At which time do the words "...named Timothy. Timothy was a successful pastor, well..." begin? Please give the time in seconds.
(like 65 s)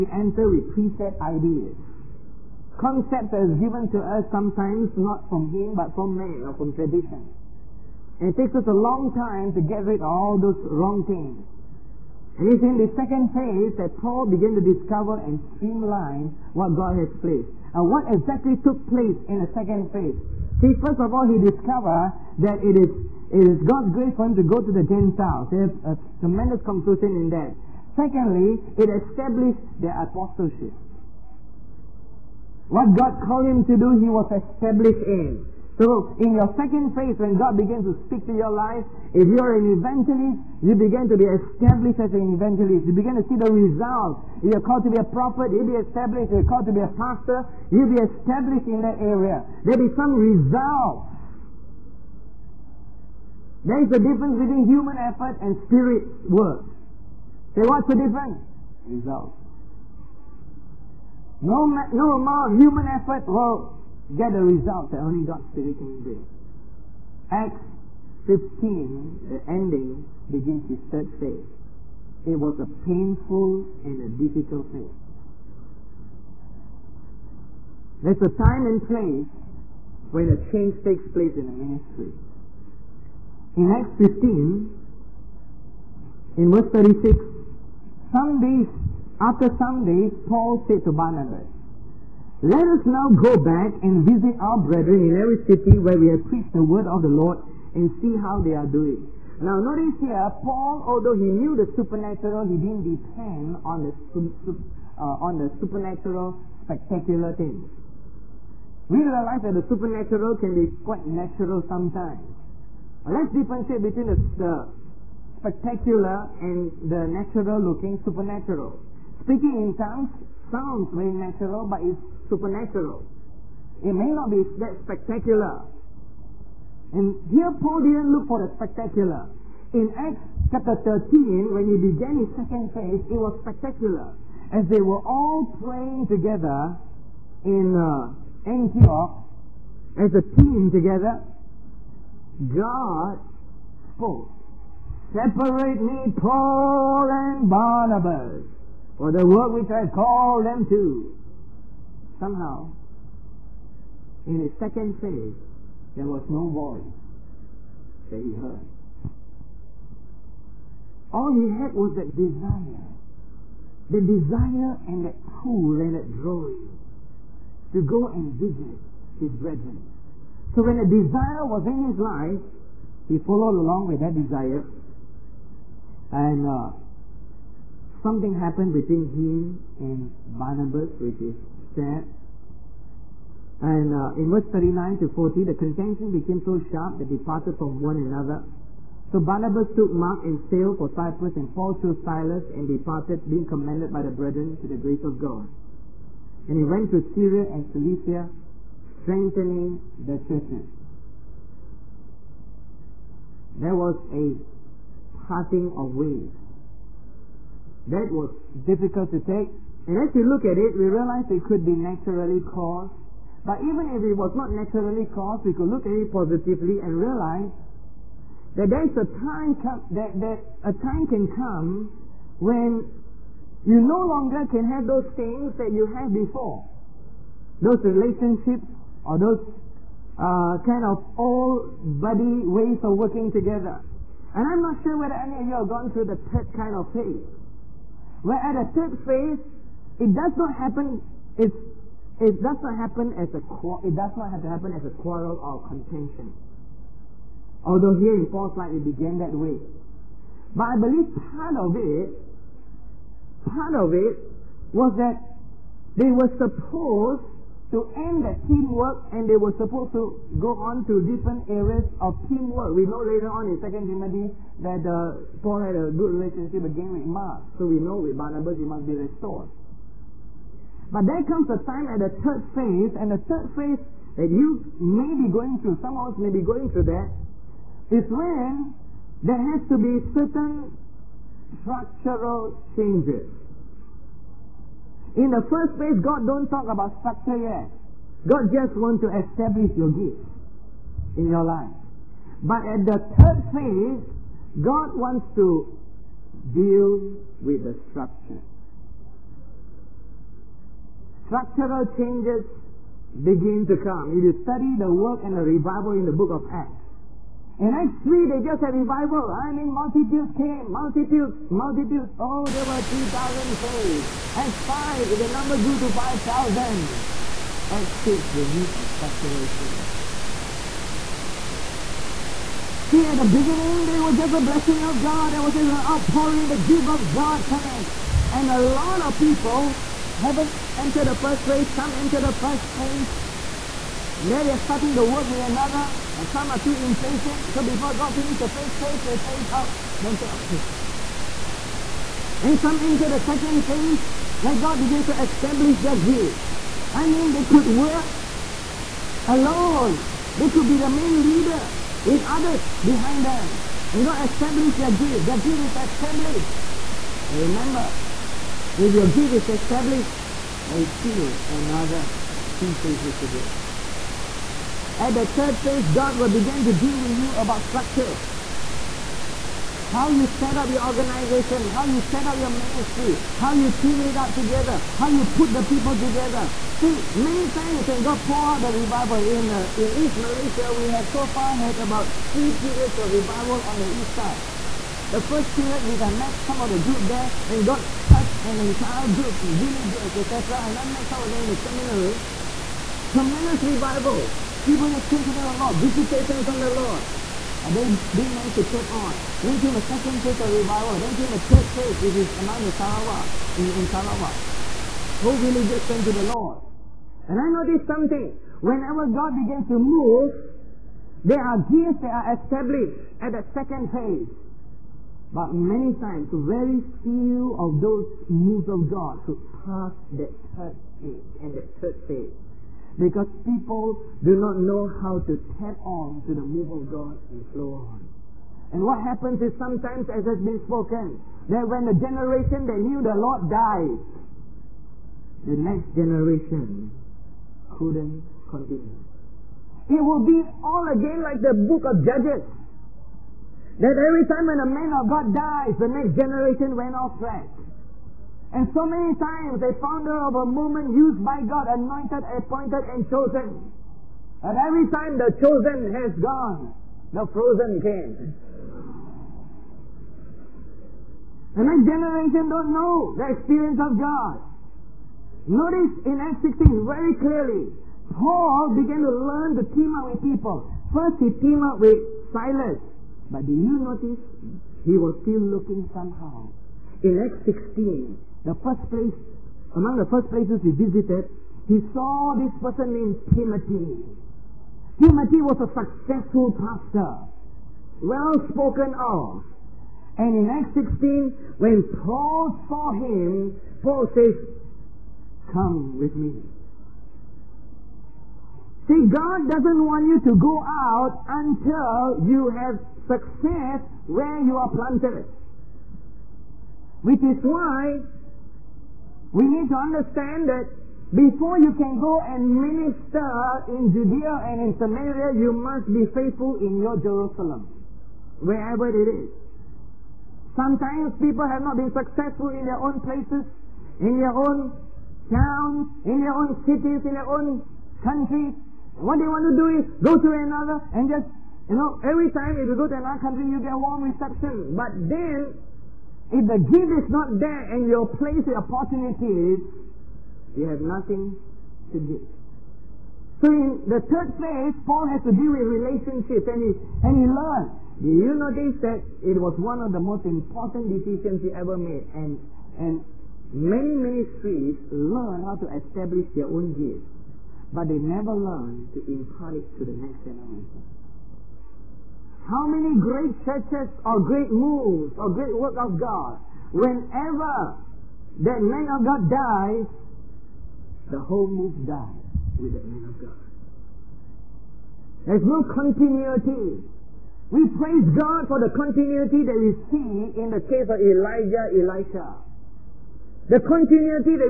482 s.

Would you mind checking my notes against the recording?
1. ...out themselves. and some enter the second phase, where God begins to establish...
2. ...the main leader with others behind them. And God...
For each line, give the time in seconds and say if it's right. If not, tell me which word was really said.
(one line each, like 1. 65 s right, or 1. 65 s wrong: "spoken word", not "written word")
1. 339 s right
2. 350 s right.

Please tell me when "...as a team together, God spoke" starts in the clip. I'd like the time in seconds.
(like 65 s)
139 s.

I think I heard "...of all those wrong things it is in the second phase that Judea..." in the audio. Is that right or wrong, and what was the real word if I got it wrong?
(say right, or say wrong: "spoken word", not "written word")
wrong: "Paul", not "Judea".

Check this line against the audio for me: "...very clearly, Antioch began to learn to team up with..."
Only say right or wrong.
wrong.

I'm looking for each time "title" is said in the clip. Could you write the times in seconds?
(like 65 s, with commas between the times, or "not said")
not said.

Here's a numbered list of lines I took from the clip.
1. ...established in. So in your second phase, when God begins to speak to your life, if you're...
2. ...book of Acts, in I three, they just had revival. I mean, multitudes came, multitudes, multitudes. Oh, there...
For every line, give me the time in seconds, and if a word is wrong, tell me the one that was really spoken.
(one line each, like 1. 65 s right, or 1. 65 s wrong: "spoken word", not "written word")
1. 34 s right
2. 306 s right.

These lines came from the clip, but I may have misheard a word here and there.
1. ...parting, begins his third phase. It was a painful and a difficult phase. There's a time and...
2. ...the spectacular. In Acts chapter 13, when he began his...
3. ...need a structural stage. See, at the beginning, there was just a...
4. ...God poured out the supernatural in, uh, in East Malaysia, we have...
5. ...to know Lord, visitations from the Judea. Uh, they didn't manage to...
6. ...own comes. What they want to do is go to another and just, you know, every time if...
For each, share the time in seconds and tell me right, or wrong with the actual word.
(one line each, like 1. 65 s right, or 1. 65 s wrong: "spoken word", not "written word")
1. 69 s wrong: "ending", not "parting"
2. 128 s right
3. 318 s wrong: "change", not "stage"
4. 378 s wrong: "revival", not "supernatural"
5. 395 s wrong: "Lord", not "Judea"
6. 527 s wrong: "countries", not "comes".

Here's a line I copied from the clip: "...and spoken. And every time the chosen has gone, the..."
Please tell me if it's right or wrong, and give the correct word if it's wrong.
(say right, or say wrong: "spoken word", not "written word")
wrong: "chosen", not "spoken".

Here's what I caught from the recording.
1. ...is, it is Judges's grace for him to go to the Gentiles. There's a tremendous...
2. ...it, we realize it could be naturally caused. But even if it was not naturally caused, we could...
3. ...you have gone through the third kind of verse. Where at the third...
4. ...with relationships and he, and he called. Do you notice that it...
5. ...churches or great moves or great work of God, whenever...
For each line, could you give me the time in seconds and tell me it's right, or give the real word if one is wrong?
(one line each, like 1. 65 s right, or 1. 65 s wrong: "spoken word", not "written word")
1. 22 s wrong: "God", not "Judges"
2. 210 s right
3. 235 s wrong: "phase", not "verse"
4. 545 s wrong: "learned", not "called"
5. 563 s right.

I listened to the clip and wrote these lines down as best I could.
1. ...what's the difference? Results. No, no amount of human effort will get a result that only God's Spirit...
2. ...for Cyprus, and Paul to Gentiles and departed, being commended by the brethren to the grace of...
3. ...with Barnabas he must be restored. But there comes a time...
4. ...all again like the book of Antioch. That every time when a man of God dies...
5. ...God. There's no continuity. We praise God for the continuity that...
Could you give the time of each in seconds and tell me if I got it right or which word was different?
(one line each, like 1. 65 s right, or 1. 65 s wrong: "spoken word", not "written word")
1. 57 s right
2. 190 s wrong: "Silas", not "Gentiles"
3. 268 s right
4. 440 s wrong: "Judges", not "Antioch"
5. 573 s right.